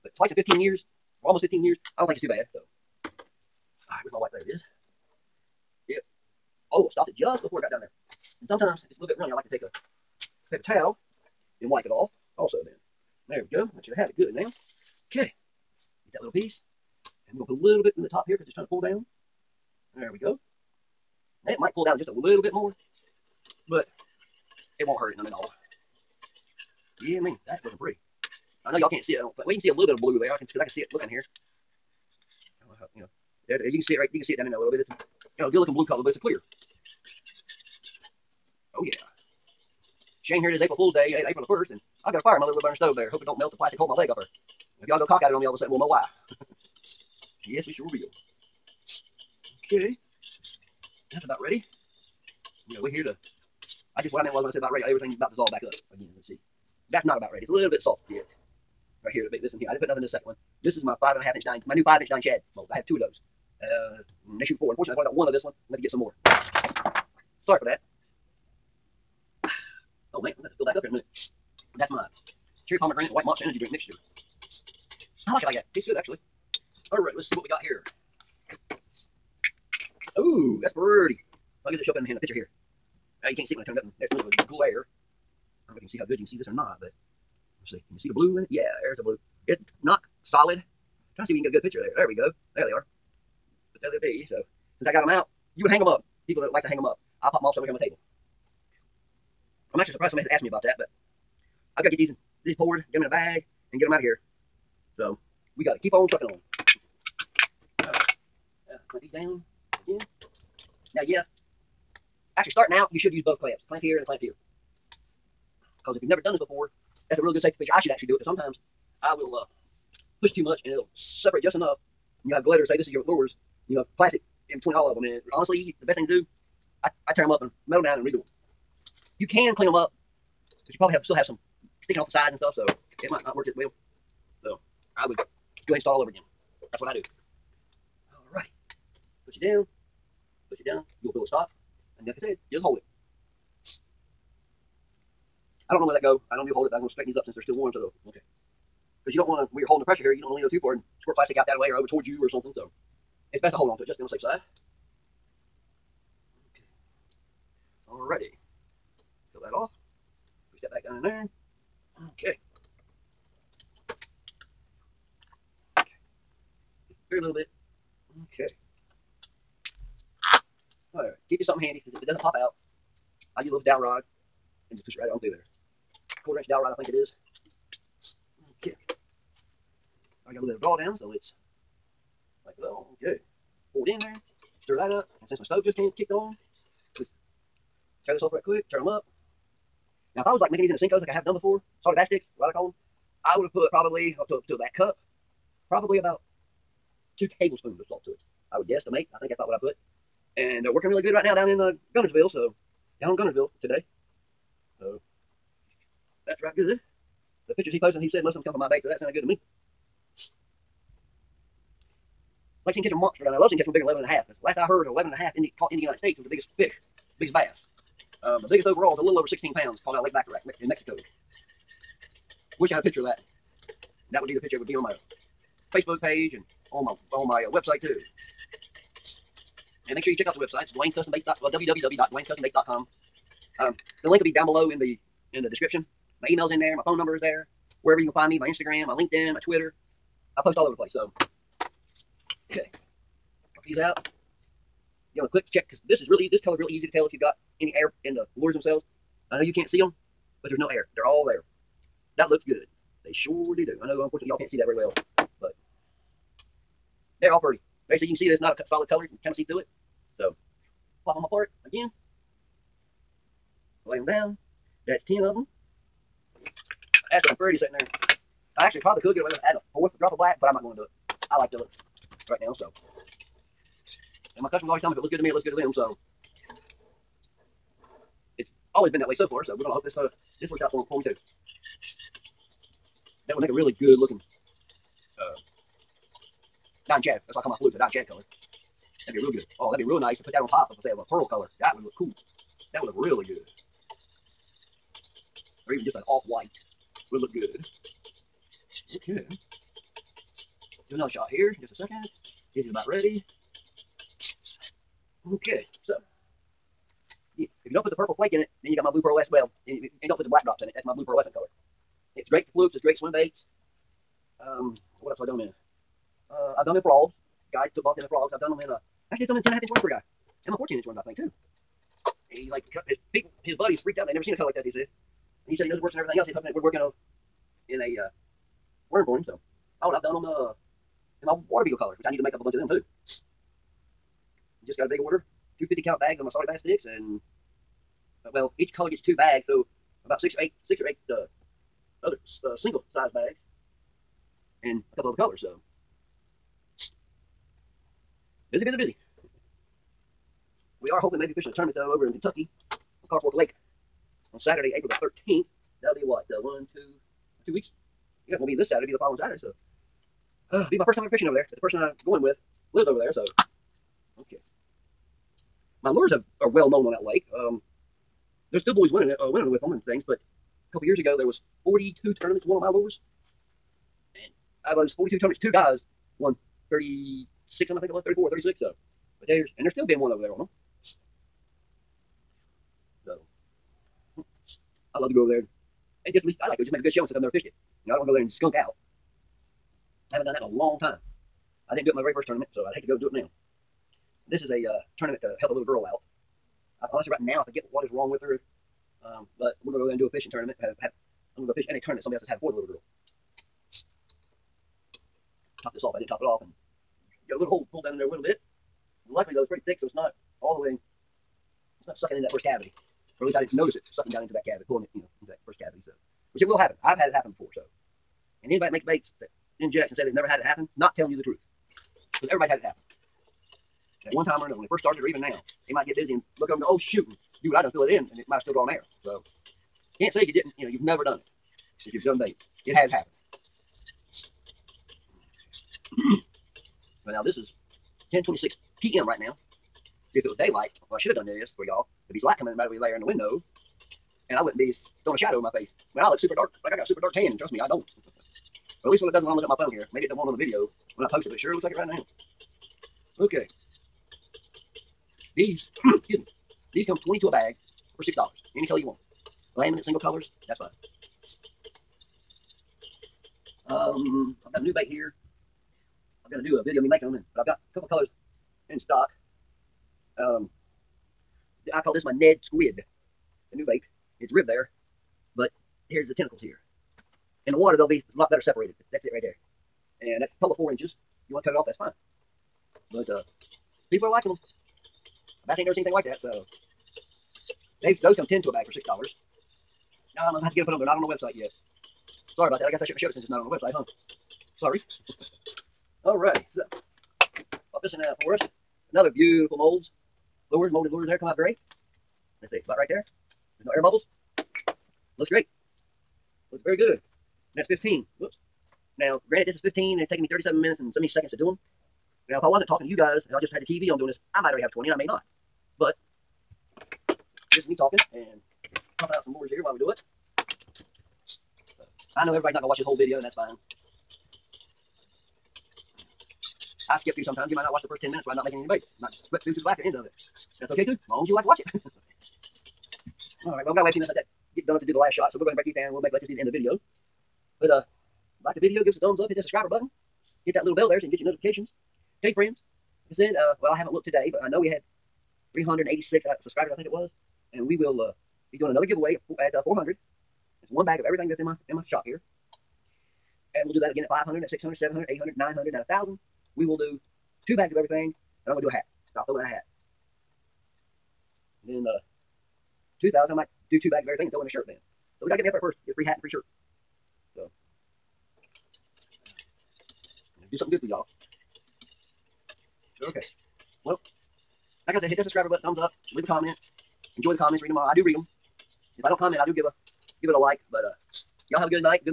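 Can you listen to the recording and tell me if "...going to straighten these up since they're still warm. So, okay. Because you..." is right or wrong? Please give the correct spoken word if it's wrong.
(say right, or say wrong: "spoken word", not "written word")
right.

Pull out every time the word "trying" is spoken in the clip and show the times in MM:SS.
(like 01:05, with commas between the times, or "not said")
00:18, 01:31.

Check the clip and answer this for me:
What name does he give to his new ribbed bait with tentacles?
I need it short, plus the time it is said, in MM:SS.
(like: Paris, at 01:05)
Ned Squid, at 07:52.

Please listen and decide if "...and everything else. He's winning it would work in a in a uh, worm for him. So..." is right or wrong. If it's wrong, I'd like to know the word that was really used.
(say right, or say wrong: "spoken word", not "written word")
wrong: "hoping", not "winning".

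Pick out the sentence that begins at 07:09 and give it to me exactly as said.
So, can't say you didn't, you know, you've never done it.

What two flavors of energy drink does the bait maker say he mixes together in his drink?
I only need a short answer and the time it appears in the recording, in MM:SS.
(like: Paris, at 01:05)
Cherry pomegranate and white, at 01:12.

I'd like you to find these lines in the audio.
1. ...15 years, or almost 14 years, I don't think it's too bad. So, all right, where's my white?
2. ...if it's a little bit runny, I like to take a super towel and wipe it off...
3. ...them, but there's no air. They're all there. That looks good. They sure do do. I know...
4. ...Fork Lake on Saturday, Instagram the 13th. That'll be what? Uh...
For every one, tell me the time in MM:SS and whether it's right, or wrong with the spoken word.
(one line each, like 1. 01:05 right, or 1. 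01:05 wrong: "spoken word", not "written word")
1. 00:00 wrong: "15", not "14"
2. 00:08 wrong: "paper", not "super"
3. 04:09 right
4. 05:53 wrong: "April", not "Instagram".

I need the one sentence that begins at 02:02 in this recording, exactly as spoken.
And you'll have glitter, say this is your lures, you have plastic in between all of them.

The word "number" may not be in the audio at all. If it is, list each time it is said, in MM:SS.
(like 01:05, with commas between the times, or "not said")
03:56.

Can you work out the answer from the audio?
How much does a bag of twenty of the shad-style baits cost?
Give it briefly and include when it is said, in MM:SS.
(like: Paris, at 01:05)
$6, at 07:38.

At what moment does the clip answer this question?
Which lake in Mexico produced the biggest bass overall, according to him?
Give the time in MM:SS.
03:40.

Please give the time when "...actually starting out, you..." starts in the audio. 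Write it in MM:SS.
01:52.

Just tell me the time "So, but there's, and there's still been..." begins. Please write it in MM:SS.
06:18.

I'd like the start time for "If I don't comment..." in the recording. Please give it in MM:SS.
09:38.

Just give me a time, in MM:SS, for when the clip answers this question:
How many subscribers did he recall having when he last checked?
09:05.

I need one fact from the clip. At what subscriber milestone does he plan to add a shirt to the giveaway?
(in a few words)
2,000.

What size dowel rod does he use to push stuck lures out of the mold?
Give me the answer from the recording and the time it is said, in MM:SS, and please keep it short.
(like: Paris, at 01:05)
Quarter inch, at 02:56.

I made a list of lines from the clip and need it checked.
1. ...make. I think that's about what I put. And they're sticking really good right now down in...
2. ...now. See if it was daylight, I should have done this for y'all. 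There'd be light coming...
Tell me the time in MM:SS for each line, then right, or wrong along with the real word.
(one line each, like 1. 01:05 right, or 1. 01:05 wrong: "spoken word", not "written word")
1. 03:18 wrong: "working", not "sticking"
2. 07:19 right.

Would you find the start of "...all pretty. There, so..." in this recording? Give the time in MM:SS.
04:17.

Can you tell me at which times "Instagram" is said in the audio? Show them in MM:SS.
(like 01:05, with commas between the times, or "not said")
03:58.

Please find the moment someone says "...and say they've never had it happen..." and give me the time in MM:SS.
06:59.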